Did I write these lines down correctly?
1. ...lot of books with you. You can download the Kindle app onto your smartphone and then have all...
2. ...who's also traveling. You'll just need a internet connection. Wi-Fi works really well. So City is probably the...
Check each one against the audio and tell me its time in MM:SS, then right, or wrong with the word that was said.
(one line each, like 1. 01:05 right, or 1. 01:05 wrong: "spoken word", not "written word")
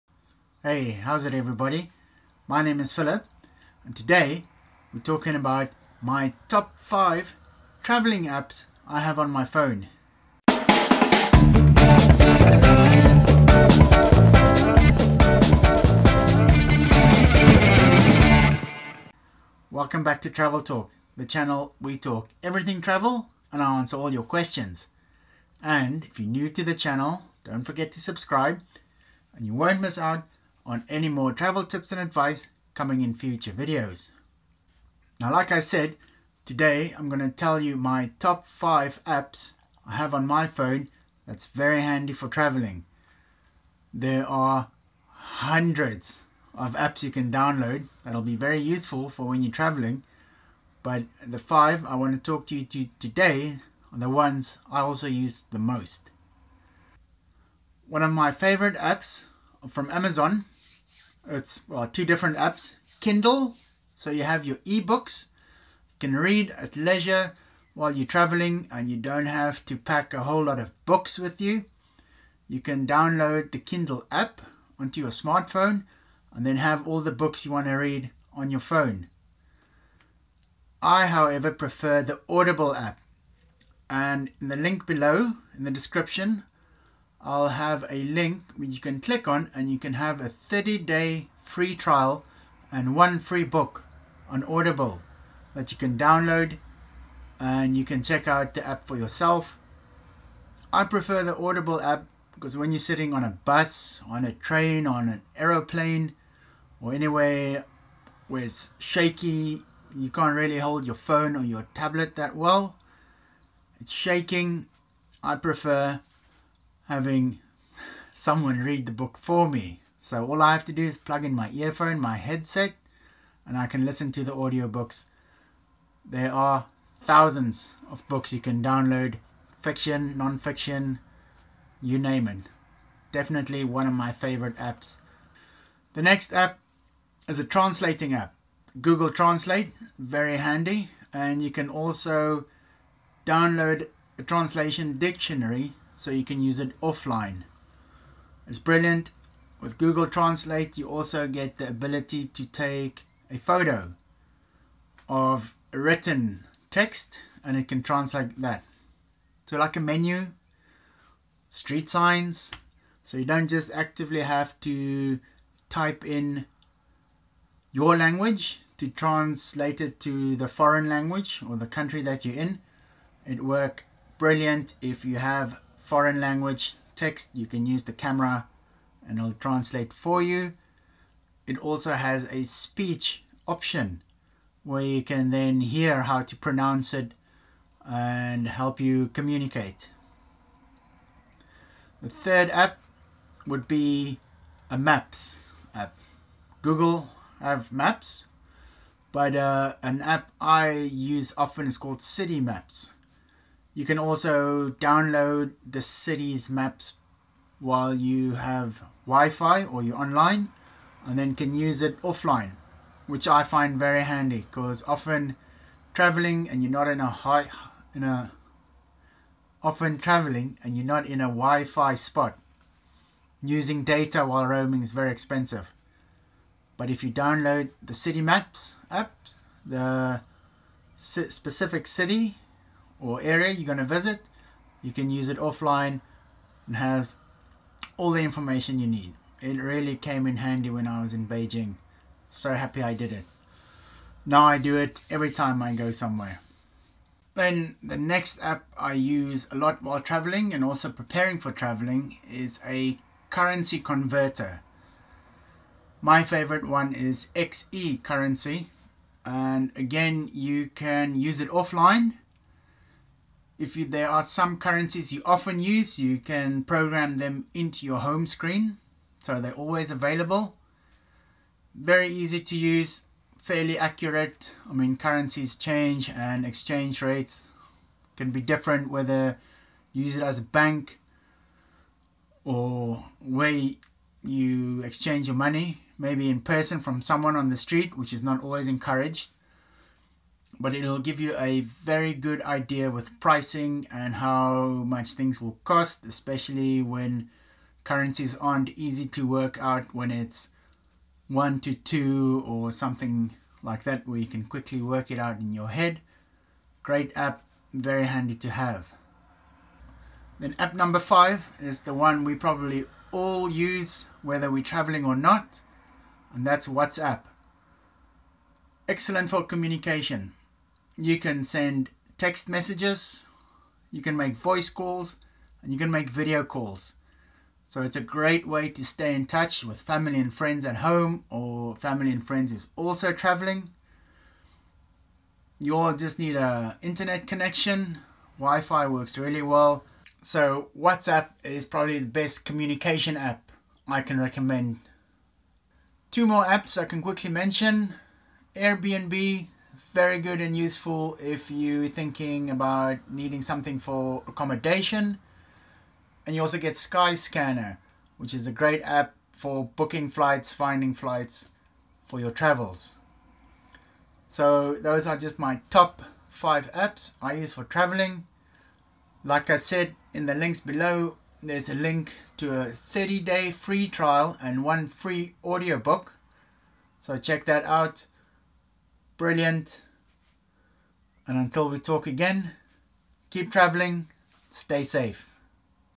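1. 01:10 right
2. 05:32 wrong: "WhatsApp", not "City".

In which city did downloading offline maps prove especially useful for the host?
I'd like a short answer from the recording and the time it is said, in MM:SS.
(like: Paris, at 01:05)
Beijing, at 04:01.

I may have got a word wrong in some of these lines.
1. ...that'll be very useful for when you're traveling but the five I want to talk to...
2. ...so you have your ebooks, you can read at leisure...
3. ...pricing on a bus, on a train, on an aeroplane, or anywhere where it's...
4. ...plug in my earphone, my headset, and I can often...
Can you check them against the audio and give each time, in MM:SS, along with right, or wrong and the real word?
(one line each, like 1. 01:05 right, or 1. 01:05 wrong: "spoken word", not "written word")
1. 00:48 right
2. 01:03 right
3. 01:42 wrong: "sitting", not "pricing"
4. 02:00 wrong: "listen", not "often".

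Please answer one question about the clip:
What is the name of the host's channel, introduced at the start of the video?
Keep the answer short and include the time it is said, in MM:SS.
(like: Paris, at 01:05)
Travel Talk, at 00:20.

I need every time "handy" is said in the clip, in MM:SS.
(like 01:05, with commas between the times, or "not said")
00:41, 02:20, 03:34, 04:00, 05:08.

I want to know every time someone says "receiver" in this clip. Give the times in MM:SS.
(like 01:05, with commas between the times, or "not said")
not said.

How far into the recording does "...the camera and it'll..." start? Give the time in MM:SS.
02:57.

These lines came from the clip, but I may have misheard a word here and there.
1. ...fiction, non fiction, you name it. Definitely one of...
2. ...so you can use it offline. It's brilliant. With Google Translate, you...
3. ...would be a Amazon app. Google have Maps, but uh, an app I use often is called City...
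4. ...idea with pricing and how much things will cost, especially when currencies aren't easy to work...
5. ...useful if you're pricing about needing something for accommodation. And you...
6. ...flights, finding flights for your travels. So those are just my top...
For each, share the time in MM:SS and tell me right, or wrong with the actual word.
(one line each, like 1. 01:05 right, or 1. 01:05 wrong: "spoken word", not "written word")
1. 02:09 right
2. 02:26 right
3. 03:13 wrong: "Maps", not "Amazon"
4. 04:52 right
5. 05:50 wrong: "thinking", not "pricing"
6. 06:00 right.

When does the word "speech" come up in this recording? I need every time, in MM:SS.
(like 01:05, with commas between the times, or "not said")
03:02.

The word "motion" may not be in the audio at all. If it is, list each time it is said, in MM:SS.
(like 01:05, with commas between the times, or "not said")
not said.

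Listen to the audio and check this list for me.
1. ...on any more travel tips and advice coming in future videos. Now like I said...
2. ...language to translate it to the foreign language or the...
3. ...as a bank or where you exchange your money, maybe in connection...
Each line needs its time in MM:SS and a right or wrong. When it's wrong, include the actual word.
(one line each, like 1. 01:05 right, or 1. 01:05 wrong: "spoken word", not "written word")
1. 00:30 right
2. 02:47 right
3. 04:40 wrong: "person", not "connection".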